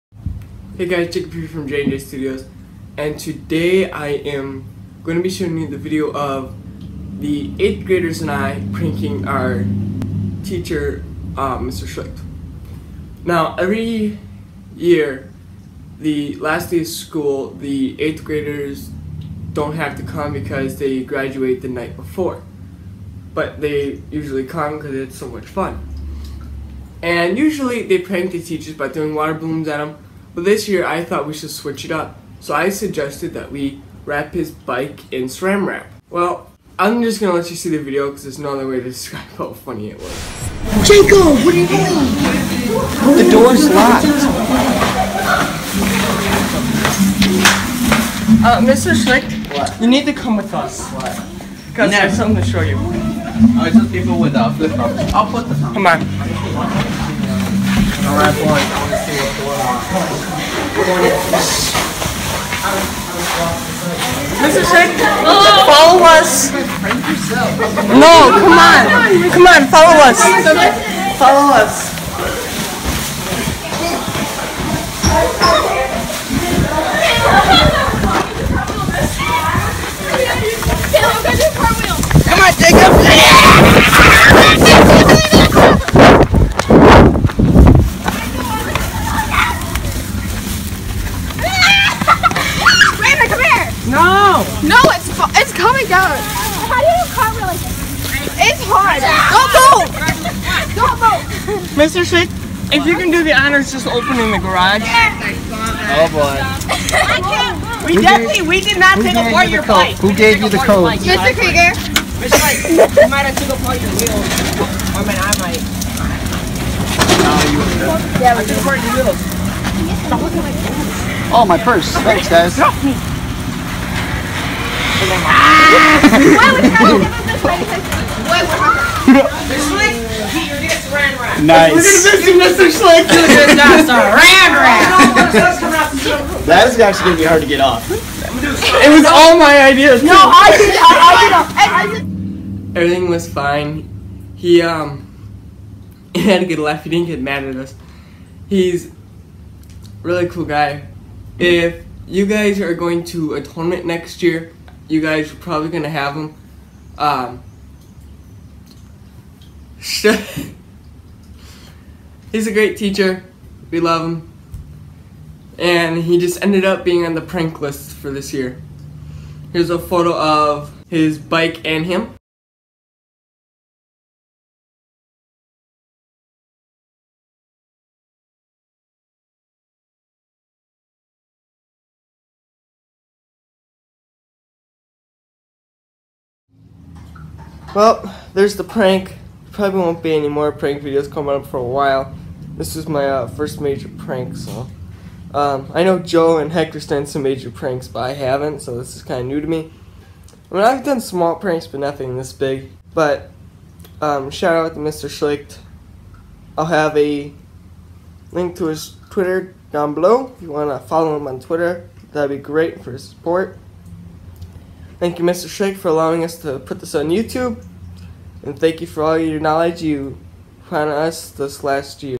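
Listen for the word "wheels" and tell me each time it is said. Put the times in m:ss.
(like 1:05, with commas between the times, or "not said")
1:53, 1:59.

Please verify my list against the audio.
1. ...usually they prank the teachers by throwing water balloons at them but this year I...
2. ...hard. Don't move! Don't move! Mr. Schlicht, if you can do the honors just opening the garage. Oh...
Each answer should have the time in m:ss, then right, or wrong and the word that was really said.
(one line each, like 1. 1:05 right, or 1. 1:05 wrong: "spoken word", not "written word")
1. 0:27 right
2. 1:38 right.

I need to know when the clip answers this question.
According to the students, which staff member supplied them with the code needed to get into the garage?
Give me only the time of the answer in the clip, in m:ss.
1:51.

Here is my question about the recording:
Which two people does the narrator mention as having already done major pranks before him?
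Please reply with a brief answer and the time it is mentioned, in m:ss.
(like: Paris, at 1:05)
Joe and Hector, at 3:15.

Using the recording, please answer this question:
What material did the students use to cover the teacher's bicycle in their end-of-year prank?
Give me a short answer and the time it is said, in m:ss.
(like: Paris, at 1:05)
Saran wrap, at 0:35.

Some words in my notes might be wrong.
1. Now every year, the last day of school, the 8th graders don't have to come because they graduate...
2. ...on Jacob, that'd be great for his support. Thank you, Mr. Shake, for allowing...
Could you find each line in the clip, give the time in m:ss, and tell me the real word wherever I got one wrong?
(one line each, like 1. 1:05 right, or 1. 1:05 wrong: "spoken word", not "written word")
1. 0:13 right
2. 3:31 wrong: "Twitter", not "Jacob".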